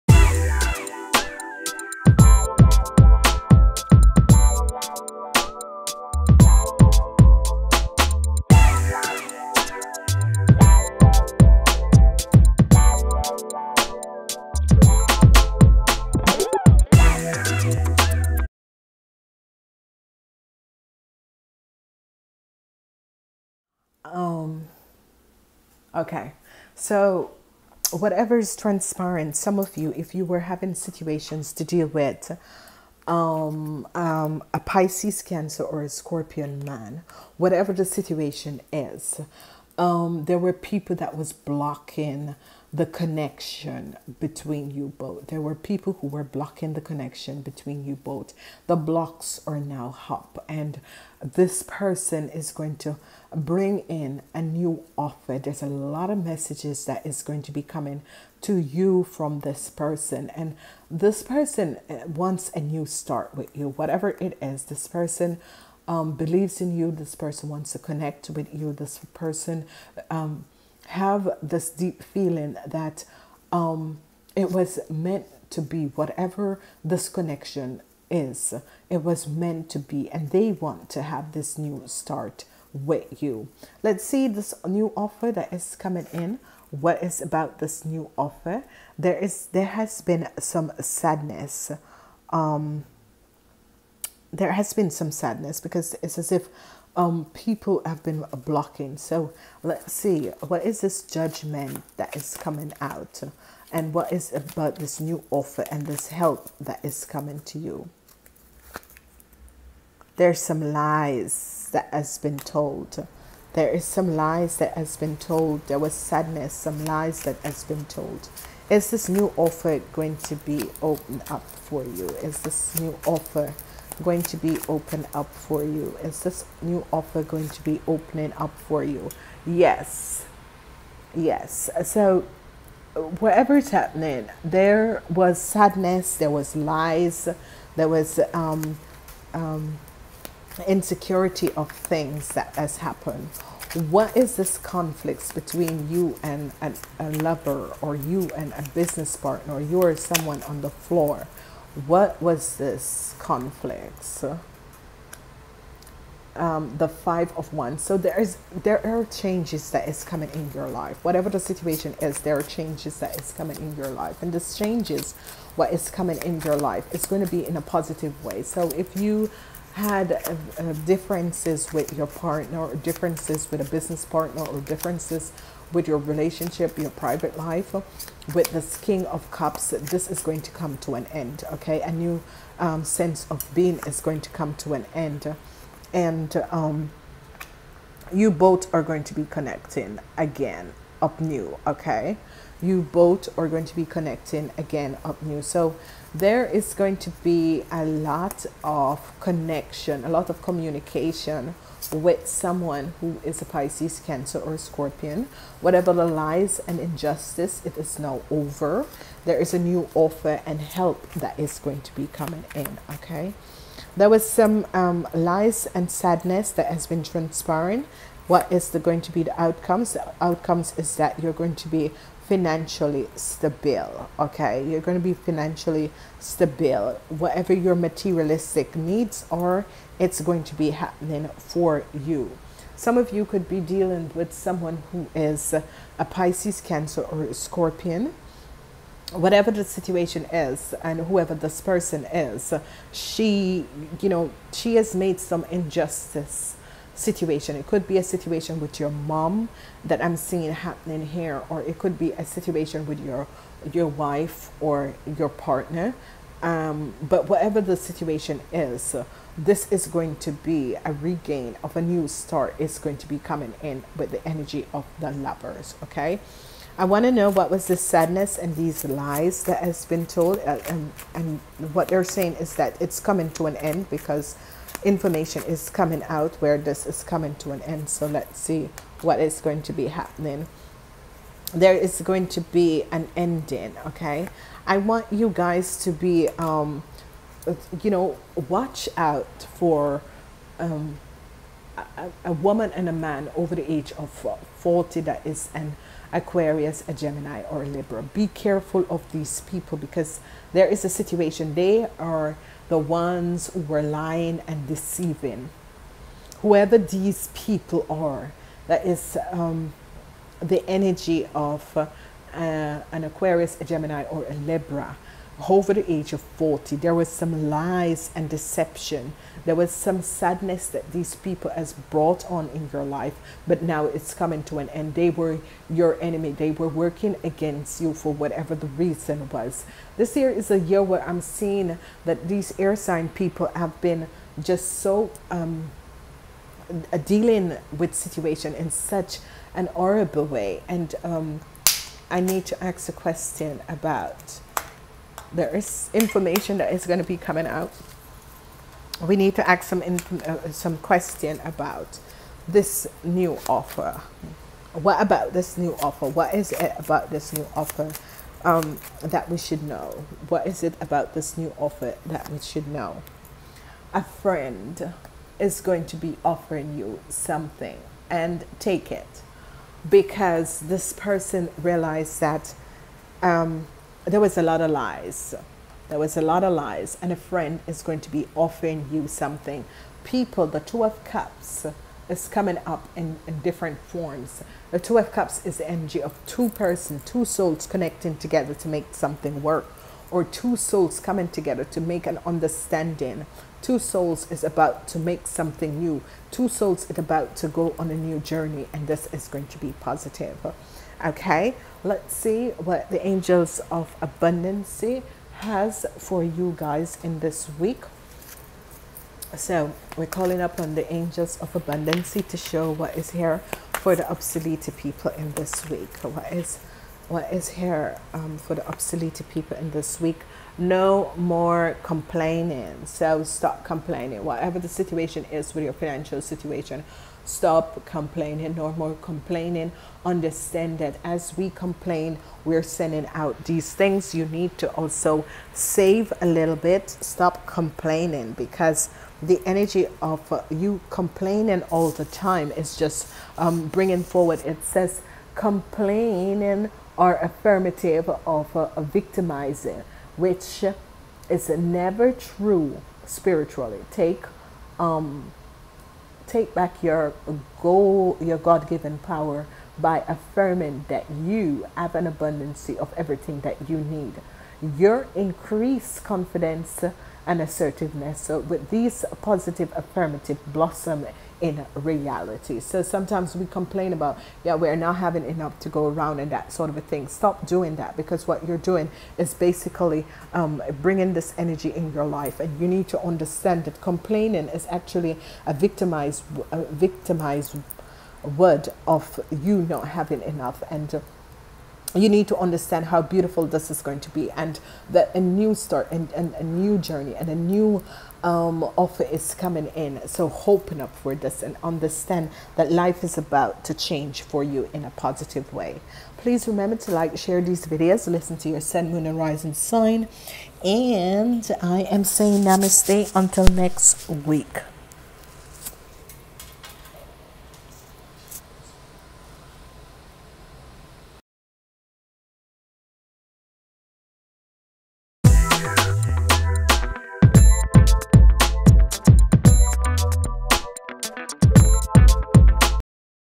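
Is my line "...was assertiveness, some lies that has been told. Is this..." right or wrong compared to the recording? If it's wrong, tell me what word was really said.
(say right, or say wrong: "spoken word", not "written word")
wrong: "sadness", not "assertiveness".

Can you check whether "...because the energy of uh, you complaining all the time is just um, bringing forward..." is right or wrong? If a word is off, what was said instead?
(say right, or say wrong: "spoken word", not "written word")
right.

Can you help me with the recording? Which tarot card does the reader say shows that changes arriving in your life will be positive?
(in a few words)
Five of Wands.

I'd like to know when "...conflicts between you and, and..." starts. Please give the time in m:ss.
2:24.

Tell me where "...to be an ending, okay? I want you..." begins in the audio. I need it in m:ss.
4:42.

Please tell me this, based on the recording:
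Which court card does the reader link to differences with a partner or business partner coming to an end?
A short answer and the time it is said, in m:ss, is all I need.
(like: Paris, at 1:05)
King of Cups, at 2:58.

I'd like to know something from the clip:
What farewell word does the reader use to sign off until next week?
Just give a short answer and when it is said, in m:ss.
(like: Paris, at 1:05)
Namaste, at 8:32.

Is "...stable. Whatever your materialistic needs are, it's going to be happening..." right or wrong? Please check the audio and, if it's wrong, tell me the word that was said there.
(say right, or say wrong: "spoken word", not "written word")
right.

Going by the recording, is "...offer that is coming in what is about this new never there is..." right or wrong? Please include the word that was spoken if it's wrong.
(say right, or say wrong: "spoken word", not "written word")
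wrong: "offer", not "never".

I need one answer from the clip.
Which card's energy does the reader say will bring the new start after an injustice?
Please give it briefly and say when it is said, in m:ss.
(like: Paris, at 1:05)
The Lovers, at 4:24.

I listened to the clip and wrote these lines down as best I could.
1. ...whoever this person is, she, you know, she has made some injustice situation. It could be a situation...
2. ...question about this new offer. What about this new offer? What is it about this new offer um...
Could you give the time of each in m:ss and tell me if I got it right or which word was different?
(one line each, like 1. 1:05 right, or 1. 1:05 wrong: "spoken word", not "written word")
1. 4:01 right
2. 5:50 right.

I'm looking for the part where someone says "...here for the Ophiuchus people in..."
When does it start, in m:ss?
6:53.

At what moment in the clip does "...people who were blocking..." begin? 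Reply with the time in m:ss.
0:45.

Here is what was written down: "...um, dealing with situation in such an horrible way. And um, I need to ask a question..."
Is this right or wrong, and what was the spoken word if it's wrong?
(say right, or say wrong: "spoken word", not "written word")
right.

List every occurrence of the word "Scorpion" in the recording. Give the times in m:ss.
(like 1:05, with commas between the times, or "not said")
0:35, 3:24, 3:57.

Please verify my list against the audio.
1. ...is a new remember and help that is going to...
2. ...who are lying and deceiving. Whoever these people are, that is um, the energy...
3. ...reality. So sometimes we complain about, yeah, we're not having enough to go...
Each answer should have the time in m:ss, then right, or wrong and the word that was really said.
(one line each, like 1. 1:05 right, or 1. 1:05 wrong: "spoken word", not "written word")
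1. 3:29 wrong: "offer", not "remember"
2. 5:03 right
3. 7:51 right.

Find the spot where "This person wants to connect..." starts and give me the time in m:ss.
1:06.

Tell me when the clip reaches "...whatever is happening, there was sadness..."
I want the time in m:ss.
2:13.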